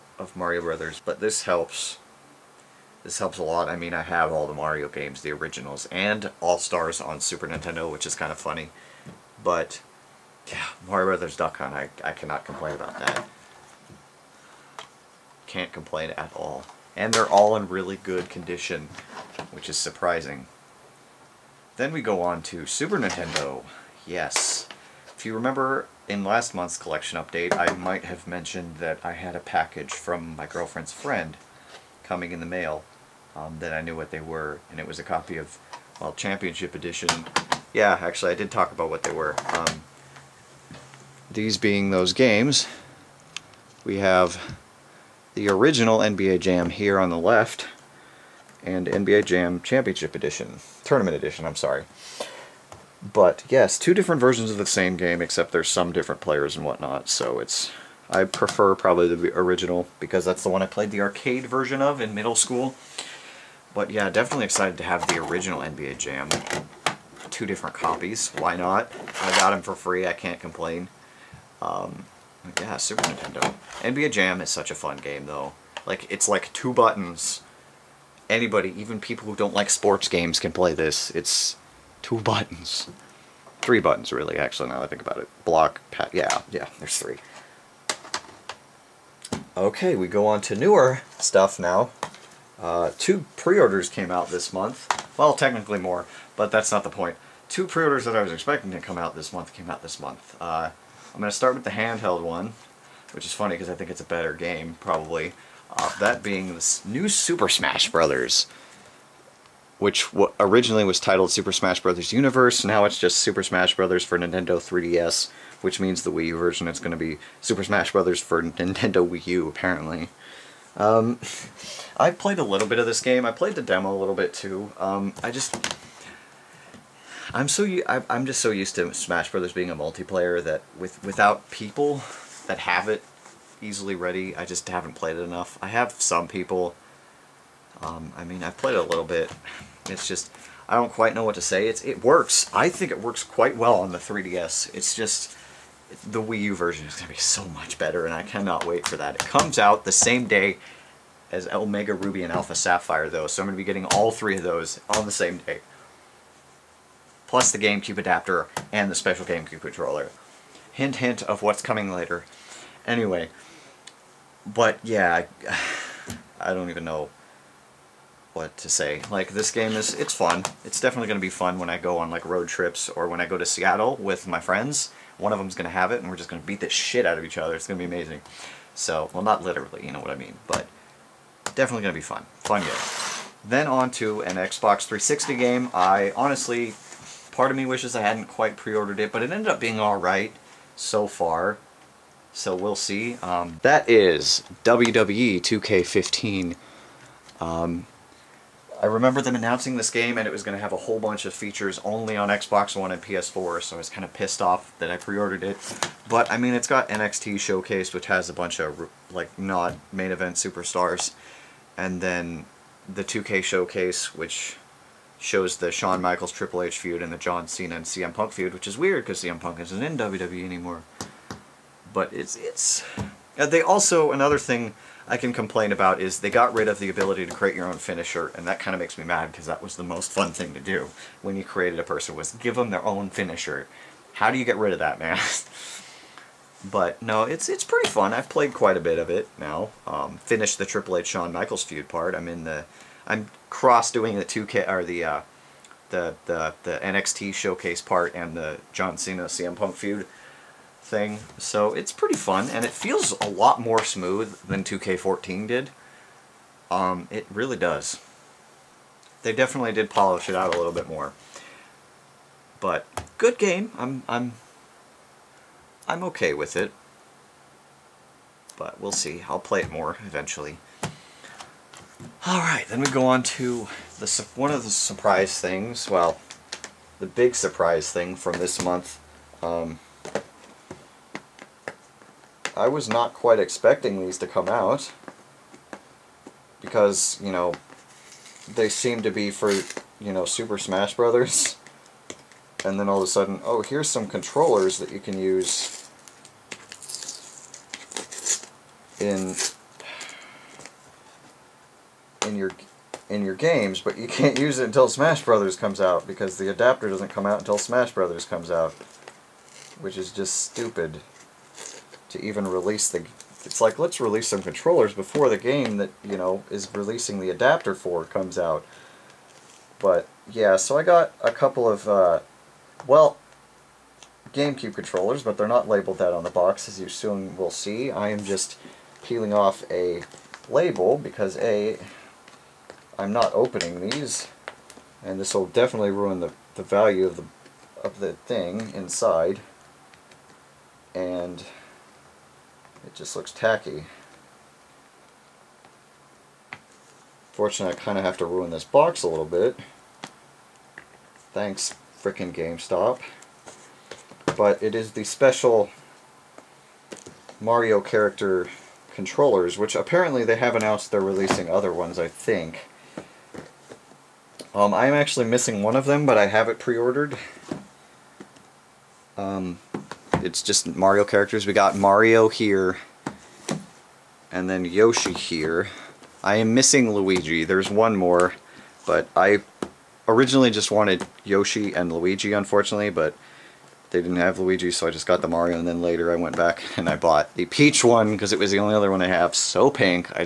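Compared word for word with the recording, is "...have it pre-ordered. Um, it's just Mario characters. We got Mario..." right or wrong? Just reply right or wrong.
right.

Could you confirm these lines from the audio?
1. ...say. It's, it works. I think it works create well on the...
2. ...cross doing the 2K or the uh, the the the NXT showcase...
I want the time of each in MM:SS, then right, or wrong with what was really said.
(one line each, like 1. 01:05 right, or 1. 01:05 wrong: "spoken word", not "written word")
1. 02:21 wrong: "quite", not "create"
2. 04:03 right.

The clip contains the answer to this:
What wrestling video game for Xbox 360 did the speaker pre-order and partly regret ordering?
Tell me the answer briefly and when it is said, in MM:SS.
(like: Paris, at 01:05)
WWE 2K15, at 03:14.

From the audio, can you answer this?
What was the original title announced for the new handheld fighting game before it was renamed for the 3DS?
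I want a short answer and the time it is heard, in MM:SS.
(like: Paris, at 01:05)
Super Smash Bros. Universe, at 01:51.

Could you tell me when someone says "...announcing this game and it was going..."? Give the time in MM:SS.
03:19.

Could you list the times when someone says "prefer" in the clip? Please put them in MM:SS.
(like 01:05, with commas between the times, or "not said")
00:58.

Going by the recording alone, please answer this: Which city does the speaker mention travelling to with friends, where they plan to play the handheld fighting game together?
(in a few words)
Seattle.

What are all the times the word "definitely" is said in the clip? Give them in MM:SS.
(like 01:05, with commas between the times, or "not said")
01:04, 02:50, 03:01, 04:19, 05:35.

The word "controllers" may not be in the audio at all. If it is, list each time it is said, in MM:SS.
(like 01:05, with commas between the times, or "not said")
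02:39, 04:54, 05:14, 05:24, 05:58.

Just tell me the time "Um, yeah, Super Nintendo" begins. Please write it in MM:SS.
01:11.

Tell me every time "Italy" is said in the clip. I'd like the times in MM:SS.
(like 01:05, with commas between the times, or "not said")
not said.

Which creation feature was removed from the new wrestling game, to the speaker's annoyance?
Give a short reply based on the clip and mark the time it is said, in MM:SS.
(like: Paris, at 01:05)
Create your own finisher, at 03:47.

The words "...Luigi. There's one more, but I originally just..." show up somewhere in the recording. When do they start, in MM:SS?
06:16.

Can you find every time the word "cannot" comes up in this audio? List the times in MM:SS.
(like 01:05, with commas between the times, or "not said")
00:12, 02:28.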